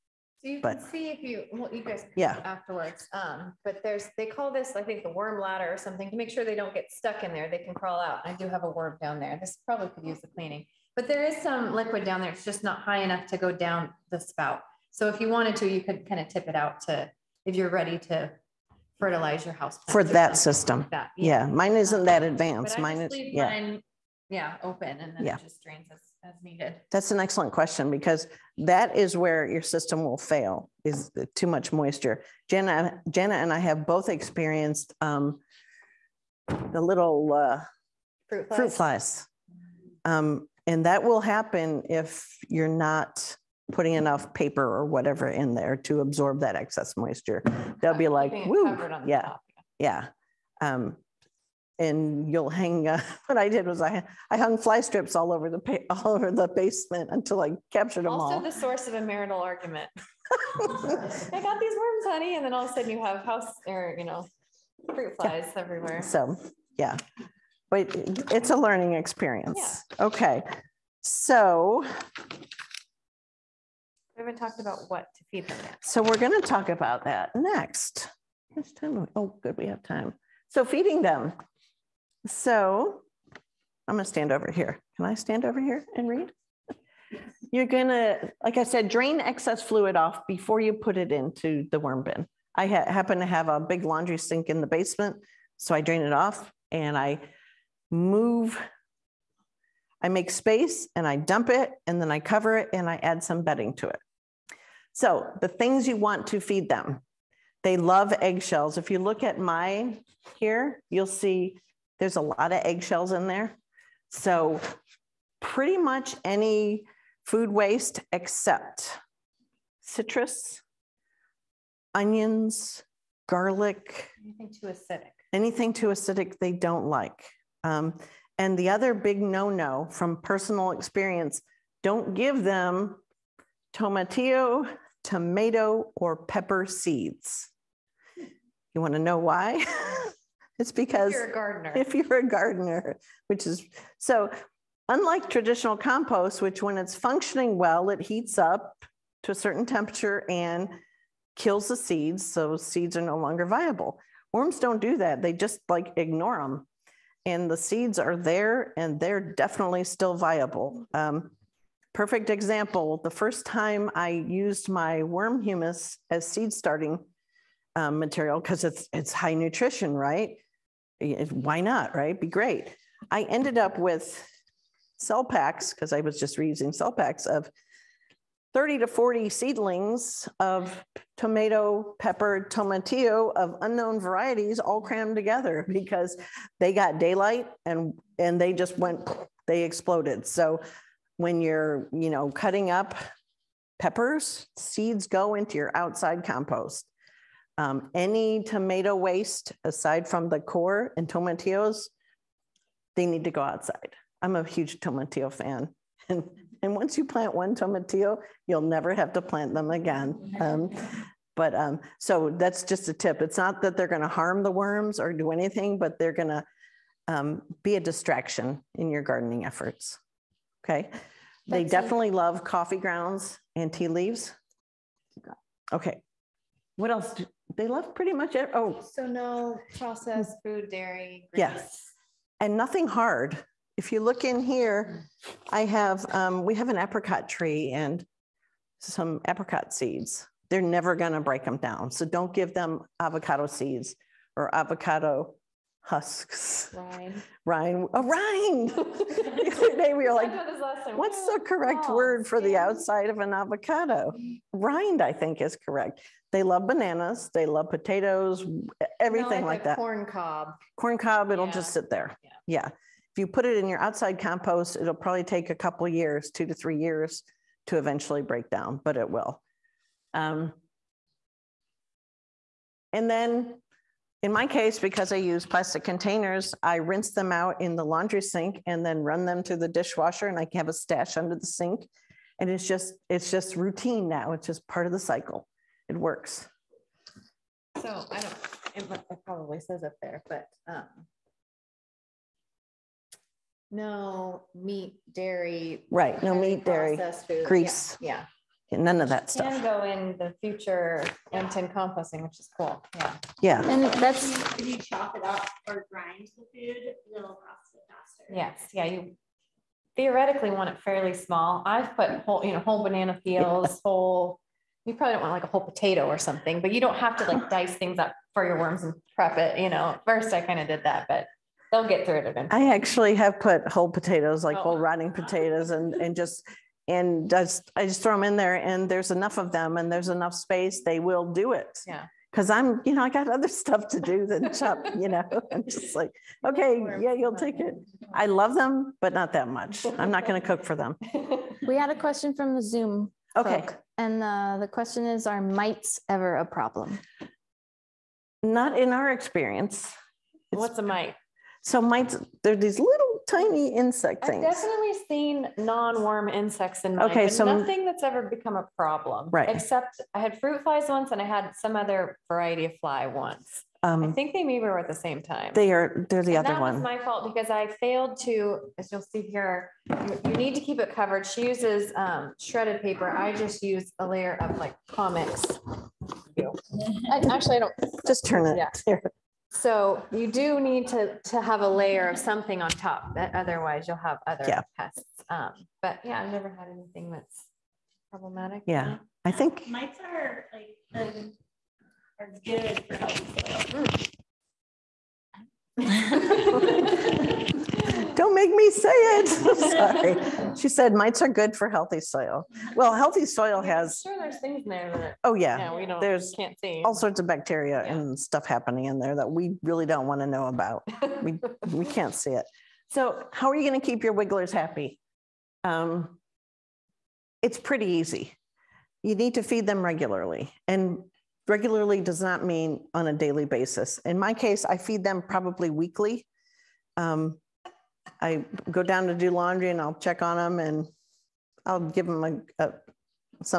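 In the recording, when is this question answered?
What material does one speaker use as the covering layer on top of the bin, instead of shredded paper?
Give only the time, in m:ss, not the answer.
6:14.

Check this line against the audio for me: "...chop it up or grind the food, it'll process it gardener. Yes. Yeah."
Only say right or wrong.
wrong.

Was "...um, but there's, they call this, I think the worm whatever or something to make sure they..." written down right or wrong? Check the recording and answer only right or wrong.
wrong.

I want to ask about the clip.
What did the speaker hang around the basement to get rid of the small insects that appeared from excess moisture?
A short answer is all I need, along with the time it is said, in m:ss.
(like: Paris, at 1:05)
fly strips, at 0:54.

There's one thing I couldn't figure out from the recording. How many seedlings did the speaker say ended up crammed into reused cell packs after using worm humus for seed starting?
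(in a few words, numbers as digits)
30 to 40.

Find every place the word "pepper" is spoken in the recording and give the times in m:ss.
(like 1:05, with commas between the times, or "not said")
2:16, 3:01, 3:13.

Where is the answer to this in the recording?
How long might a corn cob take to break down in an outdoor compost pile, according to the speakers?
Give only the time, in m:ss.
4:26.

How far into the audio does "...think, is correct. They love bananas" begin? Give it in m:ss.
4:15.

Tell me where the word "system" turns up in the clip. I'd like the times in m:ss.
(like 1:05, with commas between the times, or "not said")
0:20, 0:29.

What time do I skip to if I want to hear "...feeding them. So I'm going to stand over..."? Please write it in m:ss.
1:20.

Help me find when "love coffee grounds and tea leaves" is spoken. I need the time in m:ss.
3:42.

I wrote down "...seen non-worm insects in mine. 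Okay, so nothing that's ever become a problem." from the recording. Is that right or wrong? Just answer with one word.
right.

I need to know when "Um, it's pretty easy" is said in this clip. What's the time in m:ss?
6:55.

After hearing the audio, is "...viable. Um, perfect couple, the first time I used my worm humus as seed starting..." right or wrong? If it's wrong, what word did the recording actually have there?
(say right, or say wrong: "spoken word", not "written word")
wrong: "example", not "couple".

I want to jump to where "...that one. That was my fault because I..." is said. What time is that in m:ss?
6:06.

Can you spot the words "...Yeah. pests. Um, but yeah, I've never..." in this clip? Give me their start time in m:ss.
6:24.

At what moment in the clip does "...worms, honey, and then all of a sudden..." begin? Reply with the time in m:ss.
1:01.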